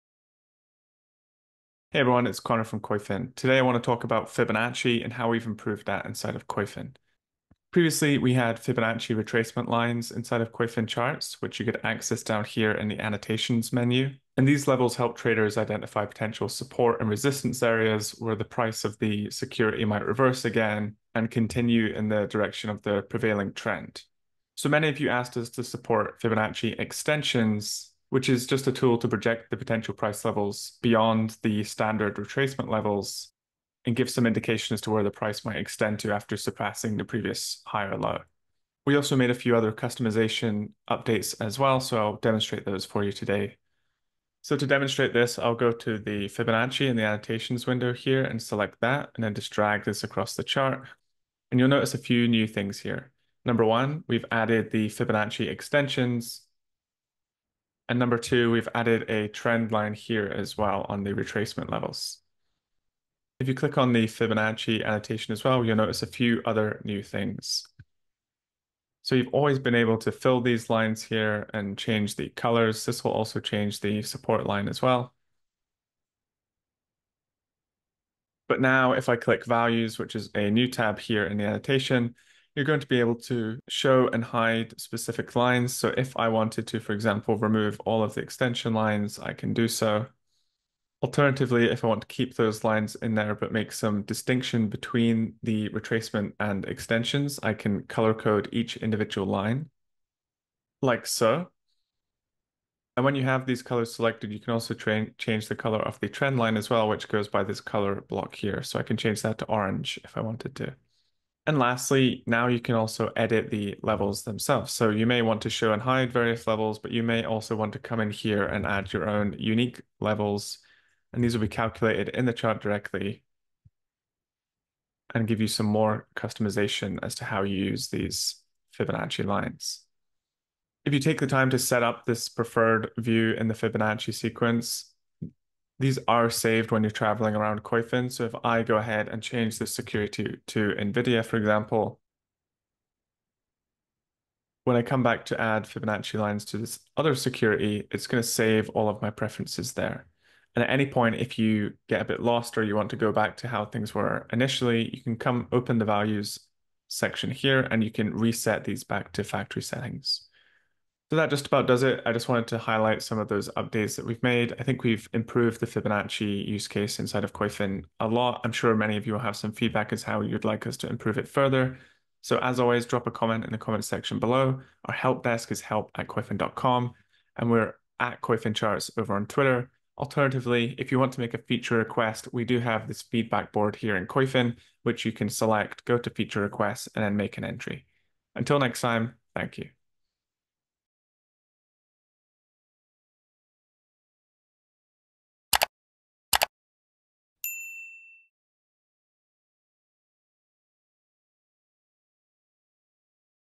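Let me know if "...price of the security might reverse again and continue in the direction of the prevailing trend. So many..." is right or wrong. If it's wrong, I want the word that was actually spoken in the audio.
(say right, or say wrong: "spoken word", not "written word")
right.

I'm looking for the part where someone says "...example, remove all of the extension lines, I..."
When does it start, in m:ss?
1:26.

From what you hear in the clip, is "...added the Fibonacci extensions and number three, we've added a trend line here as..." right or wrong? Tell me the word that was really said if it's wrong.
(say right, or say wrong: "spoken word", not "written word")
wrong: "two", not "three".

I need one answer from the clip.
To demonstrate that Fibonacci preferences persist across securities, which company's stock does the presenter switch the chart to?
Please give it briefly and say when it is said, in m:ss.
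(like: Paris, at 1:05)
NVIDIA, at 2:20.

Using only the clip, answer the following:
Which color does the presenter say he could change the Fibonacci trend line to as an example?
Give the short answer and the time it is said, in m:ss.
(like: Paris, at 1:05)
orange, at 1:49.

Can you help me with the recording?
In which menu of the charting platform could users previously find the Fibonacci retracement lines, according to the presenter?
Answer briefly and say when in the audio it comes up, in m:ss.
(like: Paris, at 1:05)
annotations menu, at 0:12.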